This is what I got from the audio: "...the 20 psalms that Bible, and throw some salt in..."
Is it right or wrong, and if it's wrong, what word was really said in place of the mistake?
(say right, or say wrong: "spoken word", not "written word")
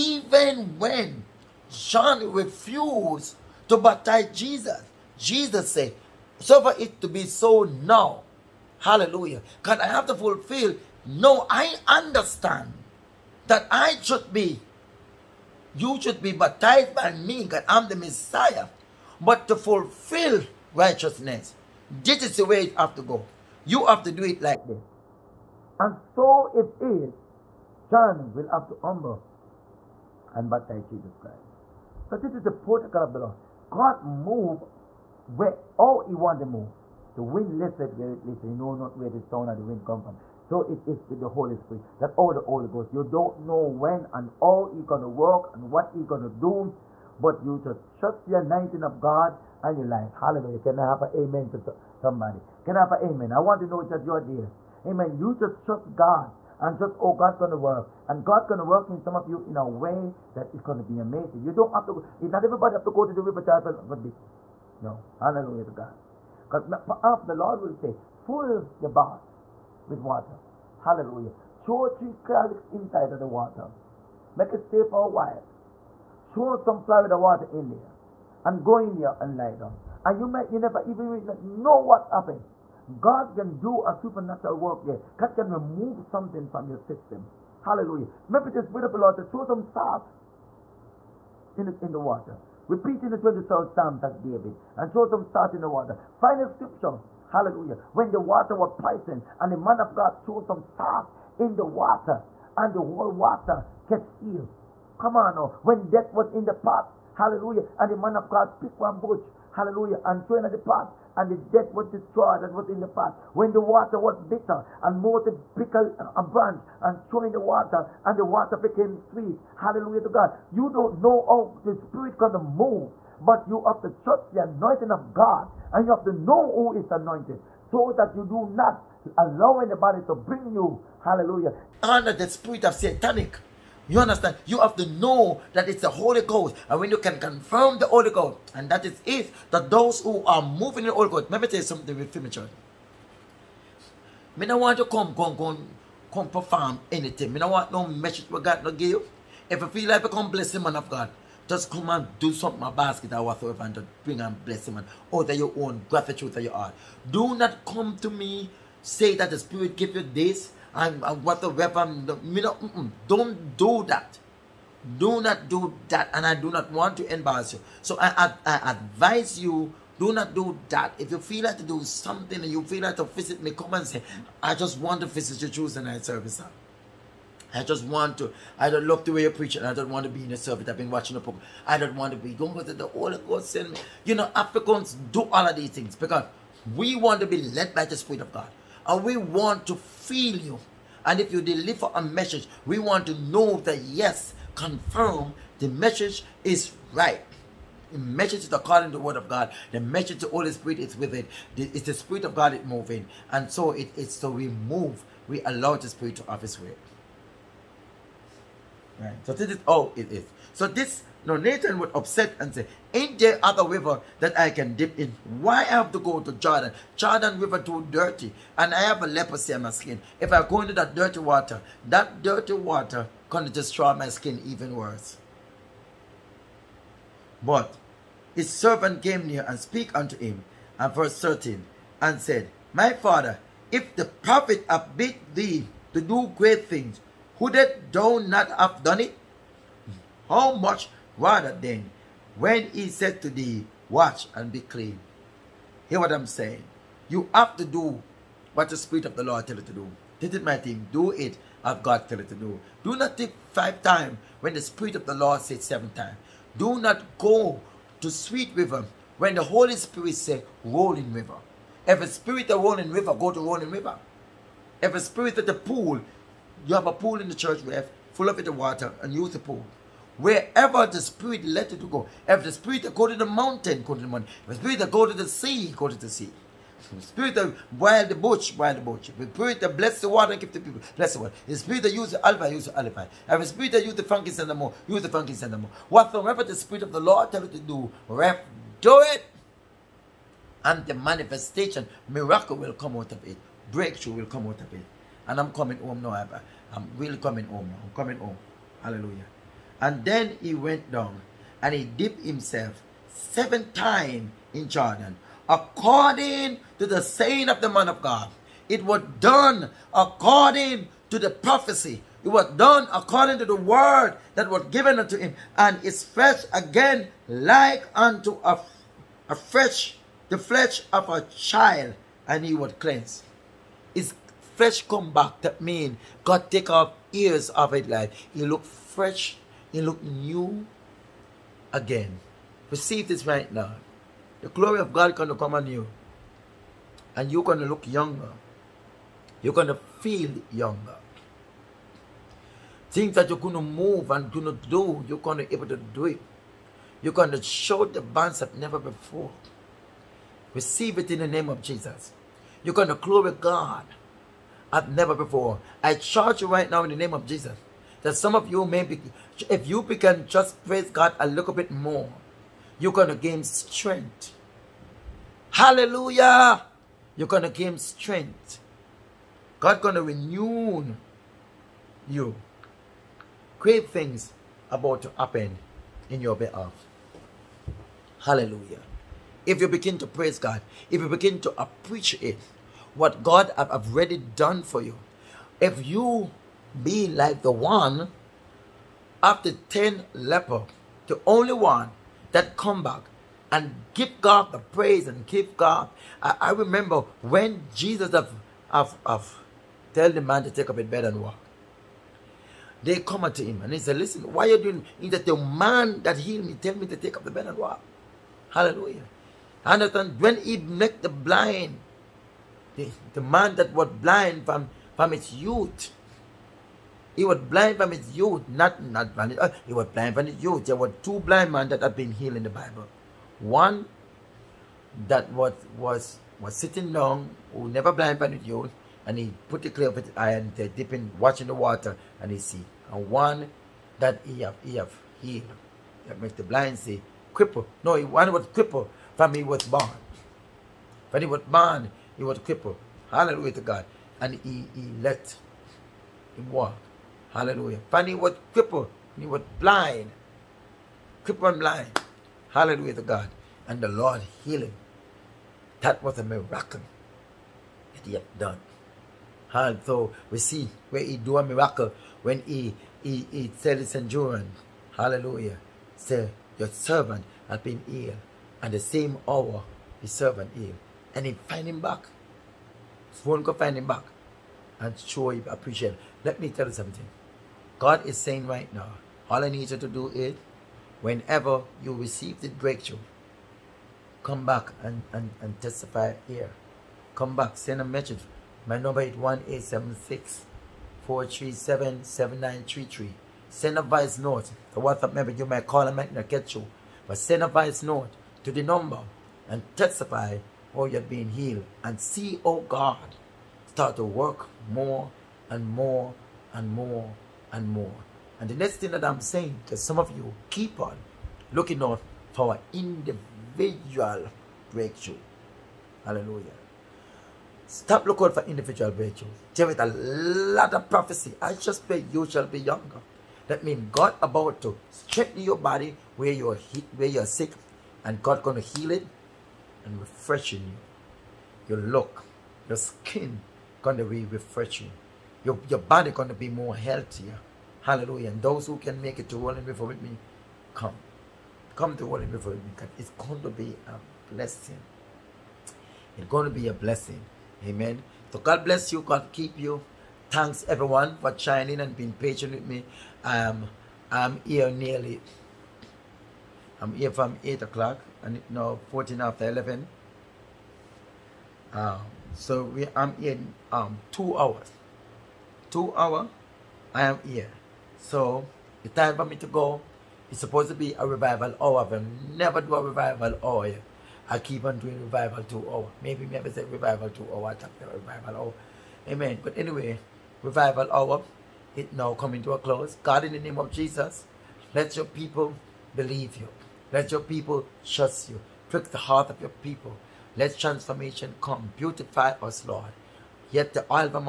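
wrong: "David", not "Bible".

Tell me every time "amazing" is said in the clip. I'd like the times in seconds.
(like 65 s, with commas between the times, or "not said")
60 s.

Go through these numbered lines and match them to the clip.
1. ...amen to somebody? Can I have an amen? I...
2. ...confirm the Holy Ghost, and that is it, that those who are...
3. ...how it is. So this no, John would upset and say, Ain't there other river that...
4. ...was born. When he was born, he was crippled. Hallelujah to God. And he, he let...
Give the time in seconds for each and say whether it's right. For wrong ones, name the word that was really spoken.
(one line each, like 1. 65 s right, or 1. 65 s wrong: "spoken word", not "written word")
1. 51 s right
2. 137 s right
3. 209 s wrong: "Naaman", not "John"
4. 439 s right.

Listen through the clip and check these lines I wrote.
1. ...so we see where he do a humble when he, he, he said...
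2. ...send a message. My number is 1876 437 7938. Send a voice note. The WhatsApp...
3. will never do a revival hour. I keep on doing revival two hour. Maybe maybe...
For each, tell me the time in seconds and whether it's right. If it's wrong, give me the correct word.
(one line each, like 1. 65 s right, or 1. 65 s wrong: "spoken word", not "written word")
1. 459 s wrong: "miracle", not "humble"
2. 487 s wrong: "7933", not "7938"
3. 571 s right.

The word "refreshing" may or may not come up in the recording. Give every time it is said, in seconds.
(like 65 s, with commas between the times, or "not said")
529 s, 534 s.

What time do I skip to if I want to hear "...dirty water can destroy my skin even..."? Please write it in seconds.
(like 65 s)
222 s.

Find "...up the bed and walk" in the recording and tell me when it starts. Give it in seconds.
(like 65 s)
407 s.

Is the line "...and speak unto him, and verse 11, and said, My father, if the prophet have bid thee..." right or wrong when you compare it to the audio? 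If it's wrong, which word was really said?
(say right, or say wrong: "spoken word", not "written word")
wrong: "13", not "11".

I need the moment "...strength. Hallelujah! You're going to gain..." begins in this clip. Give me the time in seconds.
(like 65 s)
363 s.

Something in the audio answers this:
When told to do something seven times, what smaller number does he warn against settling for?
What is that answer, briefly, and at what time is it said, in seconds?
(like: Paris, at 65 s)
five, at 253 s.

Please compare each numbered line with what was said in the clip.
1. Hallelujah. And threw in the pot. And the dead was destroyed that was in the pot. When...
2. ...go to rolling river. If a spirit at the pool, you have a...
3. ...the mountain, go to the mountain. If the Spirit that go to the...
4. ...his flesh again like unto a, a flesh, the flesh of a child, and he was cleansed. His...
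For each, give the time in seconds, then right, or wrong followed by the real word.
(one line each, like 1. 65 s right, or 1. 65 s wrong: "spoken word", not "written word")
1. 109 s right
2. 263 s right
3. 273 s right
4. 315 s right.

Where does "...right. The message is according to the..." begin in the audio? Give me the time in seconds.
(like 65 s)
196 s.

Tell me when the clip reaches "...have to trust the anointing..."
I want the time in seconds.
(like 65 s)
123 s.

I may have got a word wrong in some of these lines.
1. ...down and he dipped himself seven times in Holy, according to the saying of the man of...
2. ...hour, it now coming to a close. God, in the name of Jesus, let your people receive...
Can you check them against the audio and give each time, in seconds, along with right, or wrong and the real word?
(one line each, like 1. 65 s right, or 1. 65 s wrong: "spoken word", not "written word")
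1. 300 s wrong: "Jordan", not "Holy"
2. 580 s wrong: "believe", not "receive".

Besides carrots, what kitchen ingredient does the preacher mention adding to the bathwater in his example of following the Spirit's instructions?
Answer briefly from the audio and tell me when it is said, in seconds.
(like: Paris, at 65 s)
flour, at 76 s.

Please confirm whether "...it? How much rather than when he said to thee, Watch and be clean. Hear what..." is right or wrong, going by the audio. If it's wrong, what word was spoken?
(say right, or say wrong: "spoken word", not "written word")
right.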